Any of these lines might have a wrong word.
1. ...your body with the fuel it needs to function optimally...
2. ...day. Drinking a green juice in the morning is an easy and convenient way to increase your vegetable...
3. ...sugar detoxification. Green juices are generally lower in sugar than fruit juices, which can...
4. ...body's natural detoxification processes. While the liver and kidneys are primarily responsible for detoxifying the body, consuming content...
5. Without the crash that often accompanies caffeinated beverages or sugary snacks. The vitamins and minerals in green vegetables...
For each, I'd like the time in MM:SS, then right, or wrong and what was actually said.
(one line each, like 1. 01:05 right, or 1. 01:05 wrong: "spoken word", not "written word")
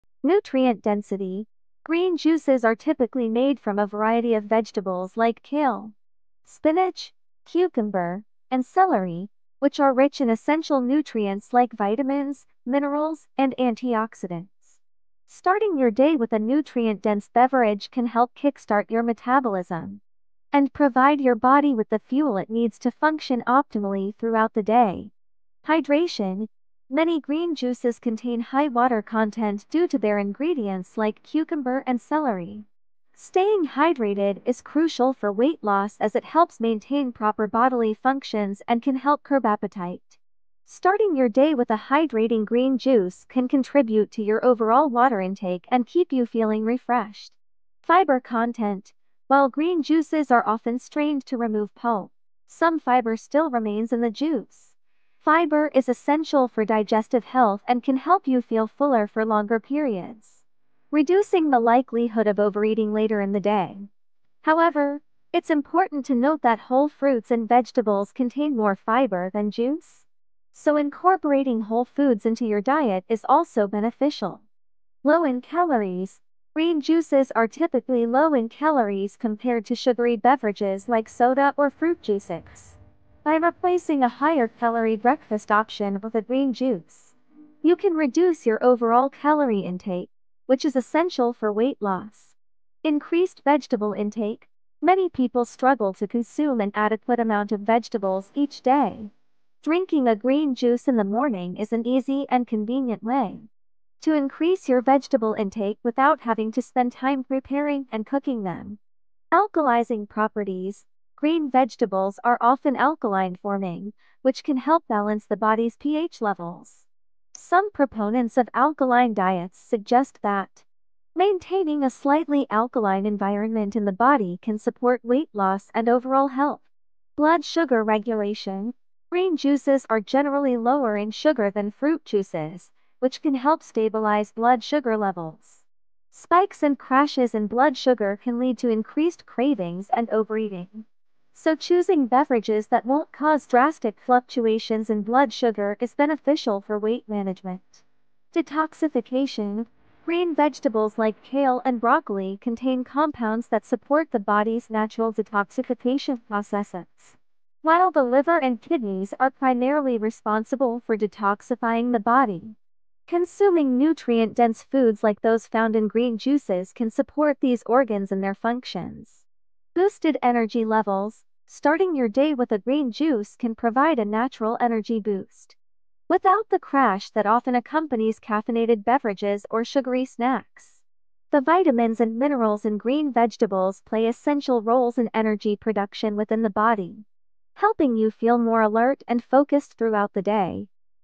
1. 00:21 right
2. 01:38 right
3. 02:07 wrong: "regulation", not "detoxification"
4. 02:34 wrong: "nutrient", not "content"
5. 02:56 right.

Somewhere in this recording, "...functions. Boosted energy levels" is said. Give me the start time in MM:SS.
02:48.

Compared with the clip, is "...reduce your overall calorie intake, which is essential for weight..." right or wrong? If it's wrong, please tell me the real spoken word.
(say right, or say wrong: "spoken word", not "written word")
right.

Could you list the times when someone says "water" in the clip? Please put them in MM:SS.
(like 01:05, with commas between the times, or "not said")
00:28, 00:44.